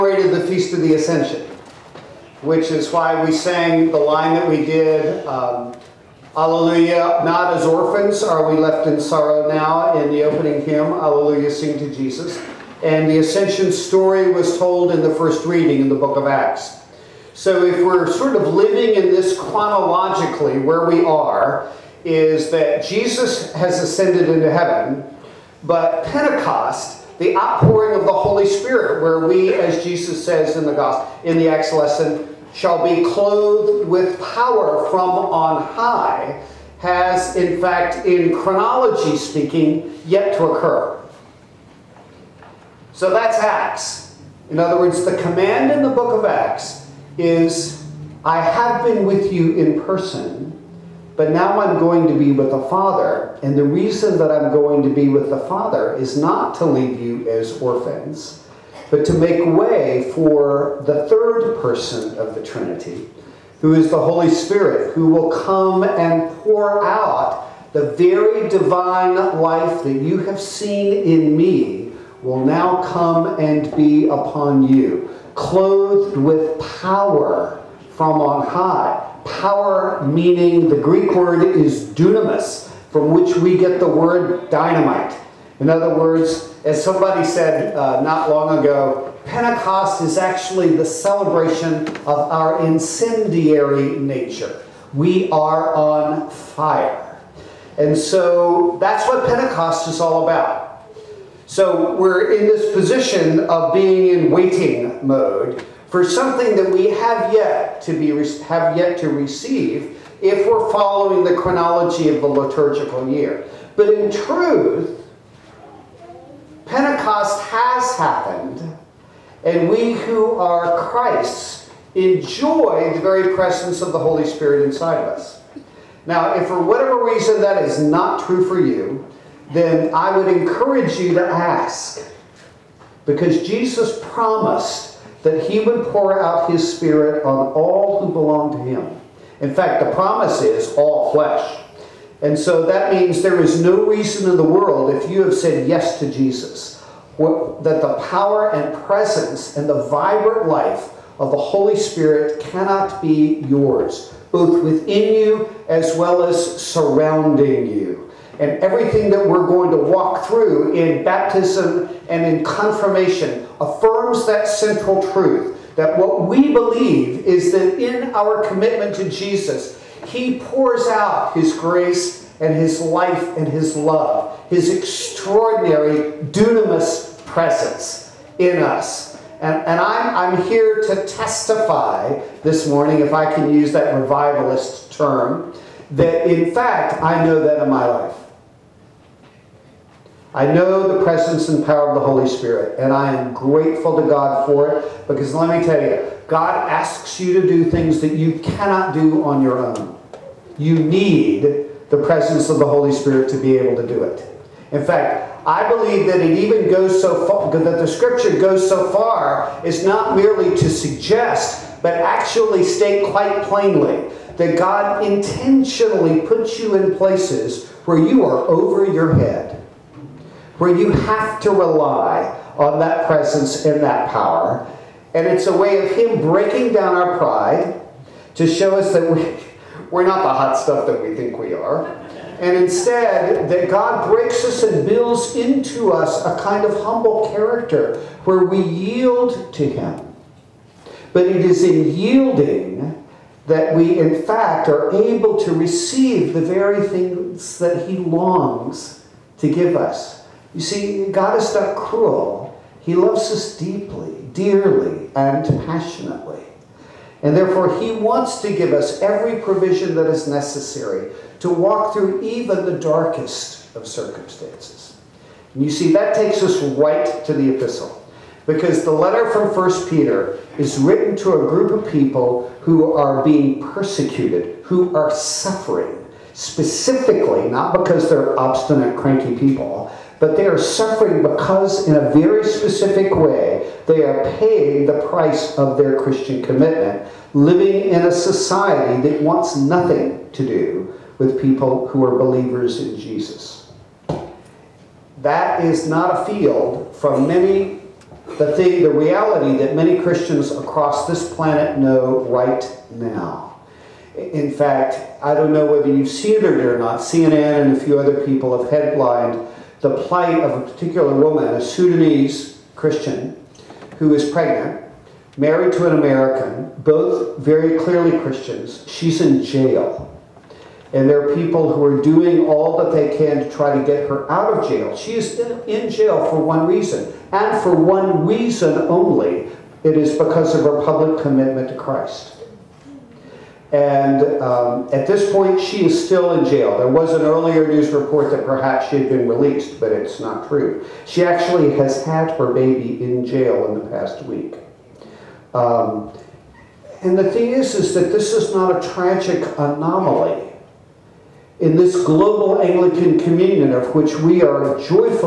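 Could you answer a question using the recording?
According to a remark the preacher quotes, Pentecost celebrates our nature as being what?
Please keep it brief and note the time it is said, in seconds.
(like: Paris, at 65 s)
incendiary, at 92 s.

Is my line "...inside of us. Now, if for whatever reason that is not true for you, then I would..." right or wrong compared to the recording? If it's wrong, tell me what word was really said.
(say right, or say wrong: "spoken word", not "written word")
right.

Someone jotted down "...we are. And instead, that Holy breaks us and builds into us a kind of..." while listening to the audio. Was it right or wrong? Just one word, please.
wrong.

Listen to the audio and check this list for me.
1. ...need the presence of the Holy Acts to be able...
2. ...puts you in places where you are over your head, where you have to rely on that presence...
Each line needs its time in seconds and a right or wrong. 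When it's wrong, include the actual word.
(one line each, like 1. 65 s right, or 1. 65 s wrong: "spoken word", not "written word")
1. 200 s wrong: "Spirit", not "Acts"
2. 216 s right.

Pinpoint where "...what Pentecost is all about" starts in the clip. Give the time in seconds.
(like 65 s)
99 s.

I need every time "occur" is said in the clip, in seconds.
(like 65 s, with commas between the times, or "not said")
40 s.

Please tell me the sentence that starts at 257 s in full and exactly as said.
And therefore, He wants to give us every provision that is necessary to walk through even the darkest of circumstances.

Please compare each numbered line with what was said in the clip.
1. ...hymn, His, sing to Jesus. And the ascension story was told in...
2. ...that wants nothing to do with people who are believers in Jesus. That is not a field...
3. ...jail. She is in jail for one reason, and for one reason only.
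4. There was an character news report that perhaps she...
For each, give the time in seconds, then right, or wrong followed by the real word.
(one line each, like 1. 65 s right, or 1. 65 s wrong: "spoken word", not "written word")
1. 10 s wrong: "Alleluia", not "His"
2. 289 s right
3. 324 s right
4. 336 s wrong: "earlier", not "character".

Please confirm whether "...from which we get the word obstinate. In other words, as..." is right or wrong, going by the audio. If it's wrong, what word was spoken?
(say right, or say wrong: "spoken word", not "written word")
wrong: "dynamite", not "obstinate".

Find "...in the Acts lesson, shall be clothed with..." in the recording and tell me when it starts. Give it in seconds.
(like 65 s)
31 s.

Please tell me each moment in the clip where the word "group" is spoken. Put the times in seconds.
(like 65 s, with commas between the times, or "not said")
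271 s.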